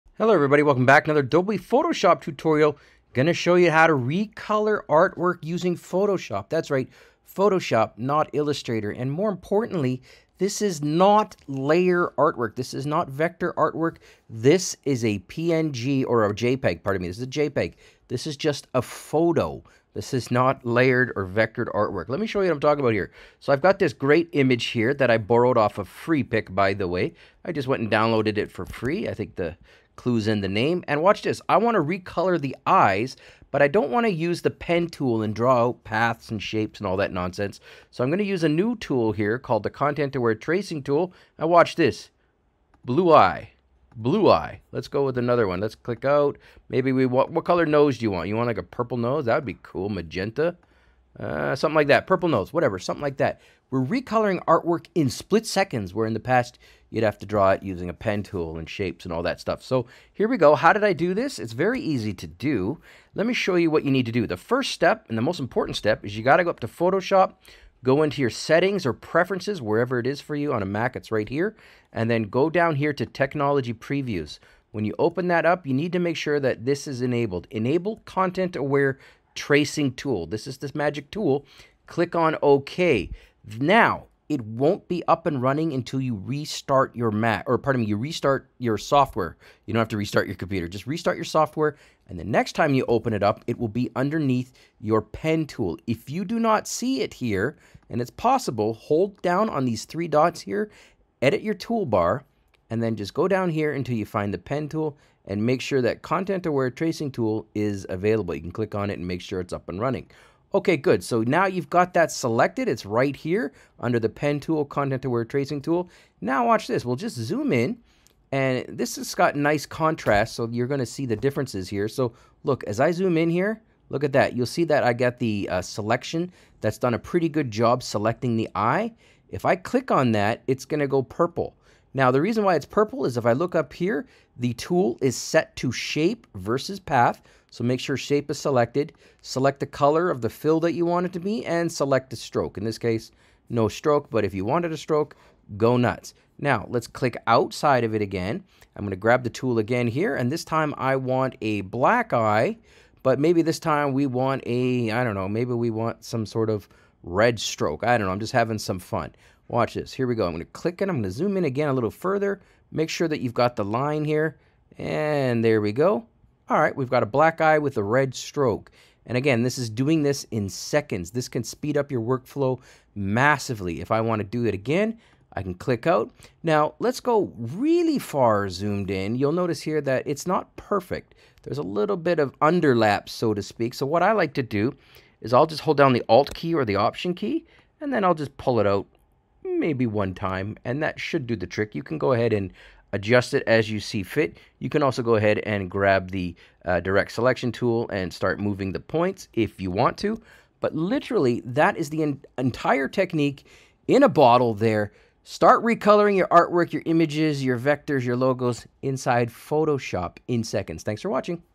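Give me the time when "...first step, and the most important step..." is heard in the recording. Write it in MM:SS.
01:04.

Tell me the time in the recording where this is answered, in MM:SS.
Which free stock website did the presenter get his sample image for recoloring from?
00:25.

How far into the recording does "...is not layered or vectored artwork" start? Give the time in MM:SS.
00:20.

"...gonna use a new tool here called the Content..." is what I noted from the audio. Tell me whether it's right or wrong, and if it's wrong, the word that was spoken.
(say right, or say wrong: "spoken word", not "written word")
right.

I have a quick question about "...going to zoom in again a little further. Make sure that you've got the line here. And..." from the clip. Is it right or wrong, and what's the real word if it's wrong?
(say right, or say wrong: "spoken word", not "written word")
right.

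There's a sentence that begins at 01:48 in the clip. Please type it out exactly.
You can click on it and make sure it's up and running.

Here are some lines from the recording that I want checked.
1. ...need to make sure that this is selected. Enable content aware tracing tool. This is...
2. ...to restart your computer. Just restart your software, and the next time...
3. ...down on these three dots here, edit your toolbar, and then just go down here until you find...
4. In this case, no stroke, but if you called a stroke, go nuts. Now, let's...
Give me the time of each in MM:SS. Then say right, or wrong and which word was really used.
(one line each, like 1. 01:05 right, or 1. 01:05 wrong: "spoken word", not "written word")
1. 01:15 wrong: "enabled", not "selected"
2. 01:29 right
3. 01:39 right
4. 02:22 wrong: "wanted", not "called".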